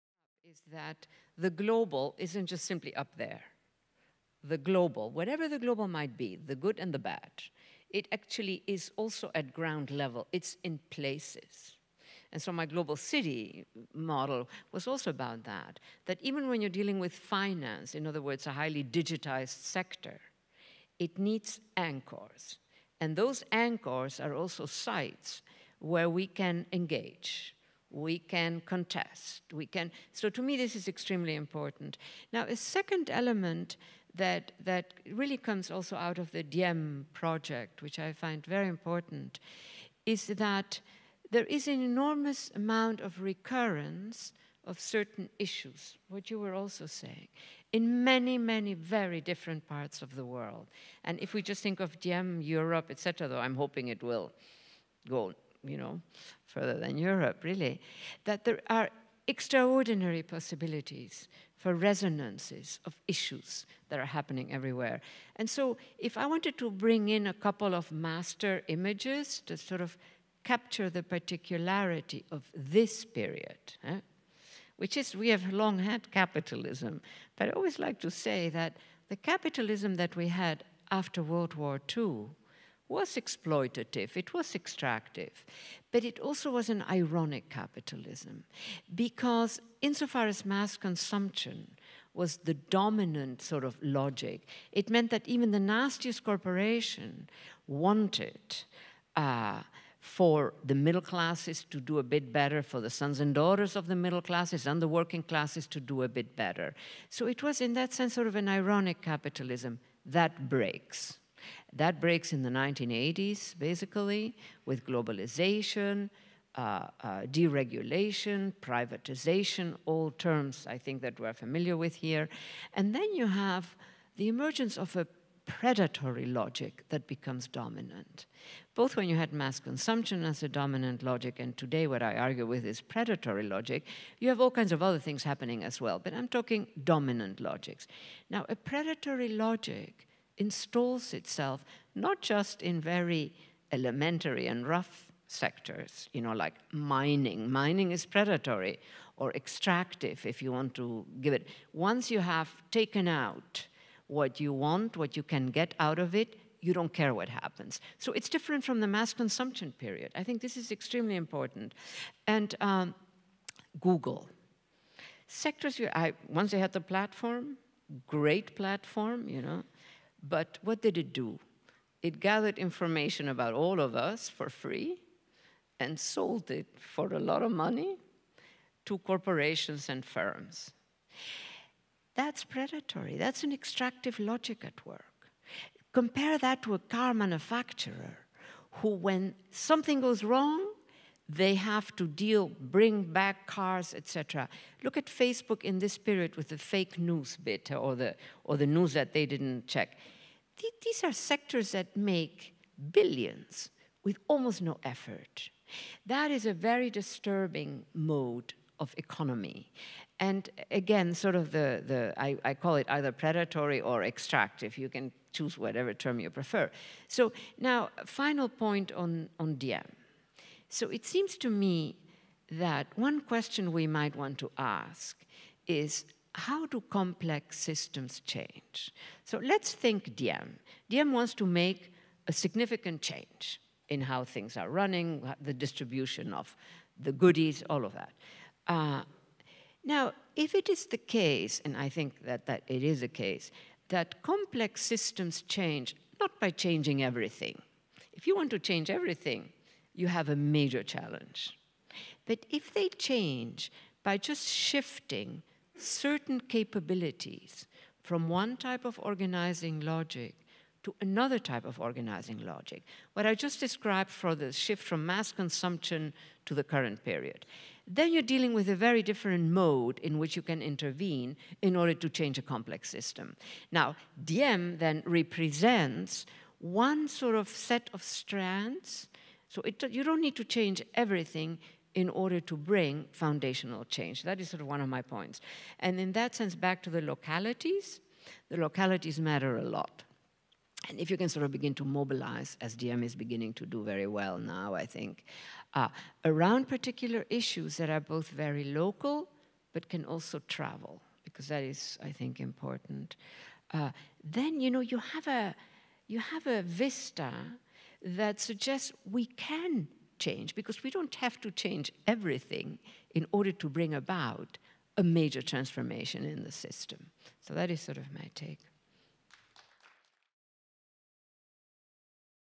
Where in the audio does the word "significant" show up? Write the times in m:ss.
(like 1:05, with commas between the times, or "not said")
3:52.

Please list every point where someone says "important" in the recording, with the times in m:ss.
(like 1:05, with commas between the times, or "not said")
0:31, 0:38, 2:41, 5:02.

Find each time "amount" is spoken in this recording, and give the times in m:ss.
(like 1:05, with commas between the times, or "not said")
0:42.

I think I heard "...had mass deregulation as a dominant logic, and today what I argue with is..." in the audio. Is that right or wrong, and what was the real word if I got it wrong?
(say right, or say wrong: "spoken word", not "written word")
wrong: "consumption", not "deregulation".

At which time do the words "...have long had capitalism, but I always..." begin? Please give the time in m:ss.
1:15.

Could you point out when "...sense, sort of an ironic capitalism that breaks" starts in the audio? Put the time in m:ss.
1:47.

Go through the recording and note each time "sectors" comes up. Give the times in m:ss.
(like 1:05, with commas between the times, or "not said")
0:19, 2:25, 2:45, 3:21.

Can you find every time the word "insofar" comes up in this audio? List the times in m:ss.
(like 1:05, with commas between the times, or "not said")
1:29.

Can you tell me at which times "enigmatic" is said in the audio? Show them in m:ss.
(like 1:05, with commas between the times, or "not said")
not said.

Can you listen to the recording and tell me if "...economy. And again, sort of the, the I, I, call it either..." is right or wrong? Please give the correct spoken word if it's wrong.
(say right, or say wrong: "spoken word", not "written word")
right.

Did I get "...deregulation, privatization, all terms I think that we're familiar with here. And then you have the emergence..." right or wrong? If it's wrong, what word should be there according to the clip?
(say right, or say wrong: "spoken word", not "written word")
right.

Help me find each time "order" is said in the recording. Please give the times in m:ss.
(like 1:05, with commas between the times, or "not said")
4:31, 4:42, 5:13.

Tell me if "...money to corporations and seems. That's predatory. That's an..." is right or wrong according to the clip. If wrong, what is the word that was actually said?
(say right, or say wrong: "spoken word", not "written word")
wrong: "firms", not "seems".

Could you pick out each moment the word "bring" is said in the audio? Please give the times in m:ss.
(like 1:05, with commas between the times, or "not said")
1:06, 3:12, 4:42, 5:13.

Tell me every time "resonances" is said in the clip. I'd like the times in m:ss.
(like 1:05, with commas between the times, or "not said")
1:01.